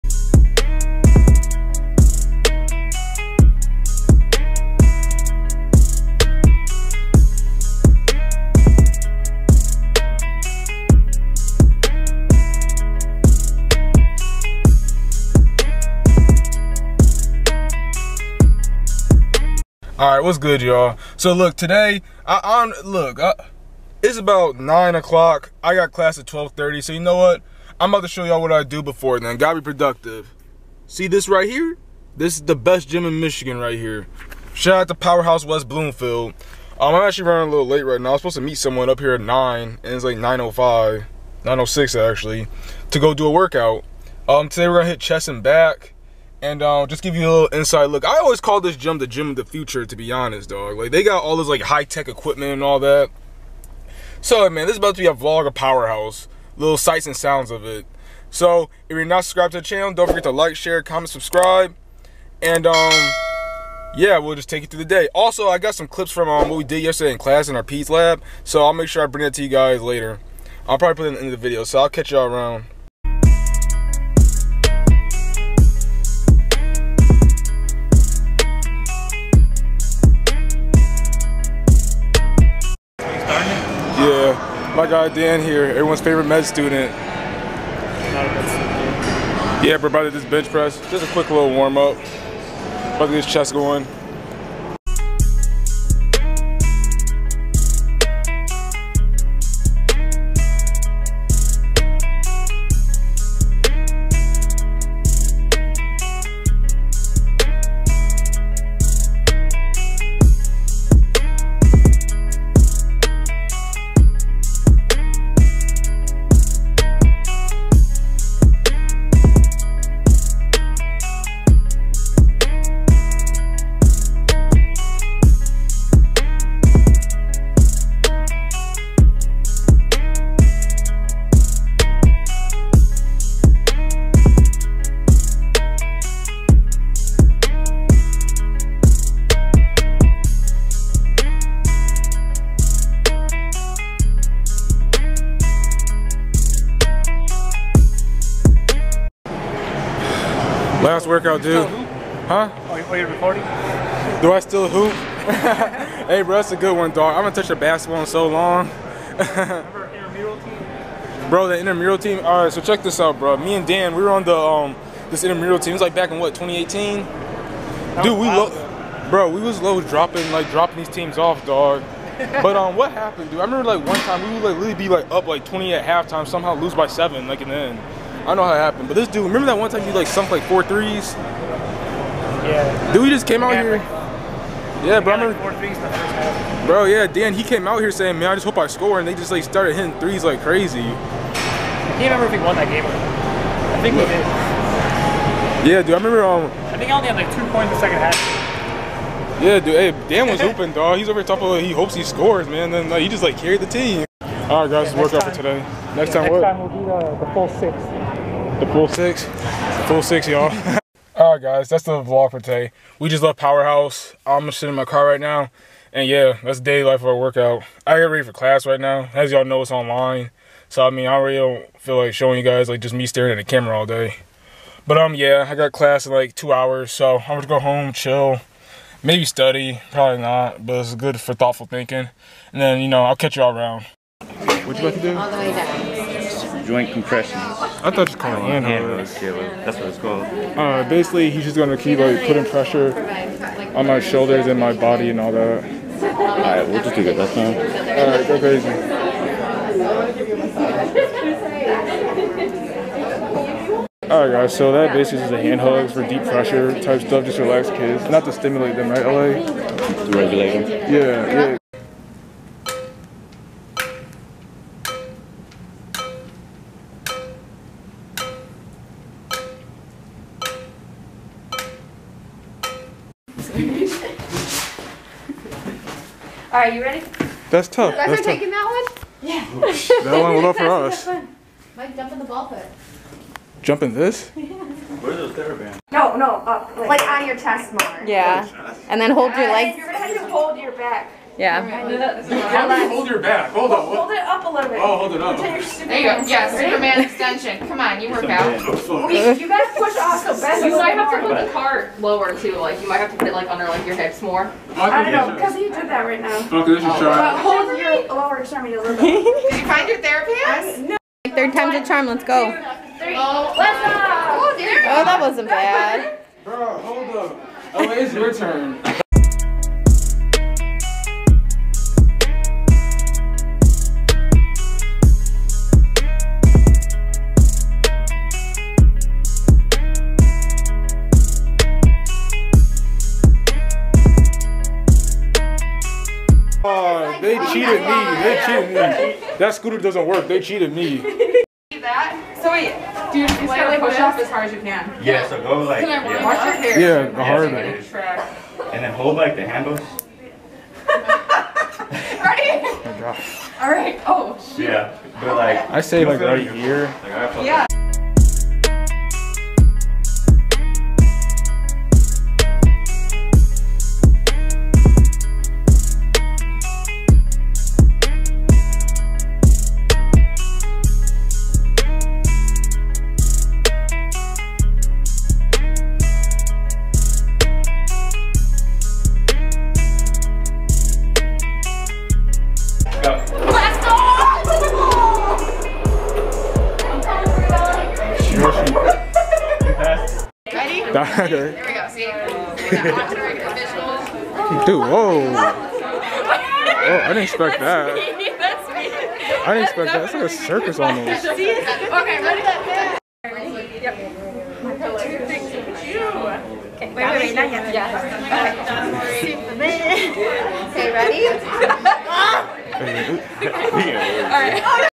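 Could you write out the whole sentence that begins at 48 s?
I always call this gym the gym of the future, to be honest, dog.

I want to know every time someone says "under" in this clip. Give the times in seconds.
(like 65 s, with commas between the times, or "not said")
303 s.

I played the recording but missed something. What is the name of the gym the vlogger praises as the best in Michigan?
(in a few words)
Powerhouse West Bloomfield.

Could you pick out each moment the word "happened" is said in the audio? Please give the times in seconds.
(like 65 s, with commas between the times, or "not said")
172 s, 178 s.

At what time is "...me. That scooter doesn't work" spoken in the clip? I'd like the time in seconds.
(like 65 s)
339 s.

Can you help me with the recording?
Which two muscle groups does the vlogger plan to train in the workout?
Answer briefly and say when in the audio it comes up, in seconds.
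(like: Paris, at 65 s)
chest and back, at 44 s.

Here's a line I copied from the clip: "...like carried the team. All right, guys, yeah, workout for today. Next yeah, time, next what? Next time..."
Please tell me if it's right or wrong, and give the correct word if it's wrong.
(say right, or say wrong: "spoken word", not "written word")
right.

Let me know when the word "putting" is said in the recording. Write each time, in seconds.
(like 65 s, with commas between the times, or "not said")
242 s.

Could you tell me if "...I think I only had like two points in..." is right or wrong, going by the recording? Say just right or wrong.
right.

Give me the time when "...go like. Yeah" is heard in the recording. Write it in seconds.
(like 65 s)
345 s.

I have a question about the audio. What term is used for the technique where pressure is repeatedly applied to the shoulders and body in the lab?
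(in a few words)
Joint compressions.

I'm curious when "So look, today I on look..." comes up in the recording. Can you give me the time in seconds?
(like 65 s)
21 s.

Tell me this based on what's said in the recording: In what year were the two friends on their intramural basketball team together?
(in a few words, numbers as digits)
2018.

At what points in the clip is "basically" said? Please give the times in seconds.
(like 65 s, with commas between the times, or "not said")
240 s, 254 s.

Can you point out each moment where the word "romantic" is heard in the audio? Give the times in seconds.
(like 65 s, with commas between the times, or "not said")
not said.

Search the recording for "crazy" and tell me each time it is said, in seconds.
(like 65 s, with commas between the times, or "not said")
190 s, 248 s.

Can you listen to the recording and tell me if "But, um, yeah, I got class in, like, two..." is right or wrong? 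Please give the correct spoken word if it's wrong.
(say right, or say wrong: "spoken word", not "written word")
right.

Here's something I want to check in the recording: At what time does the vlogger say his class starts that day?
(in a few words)
12:30.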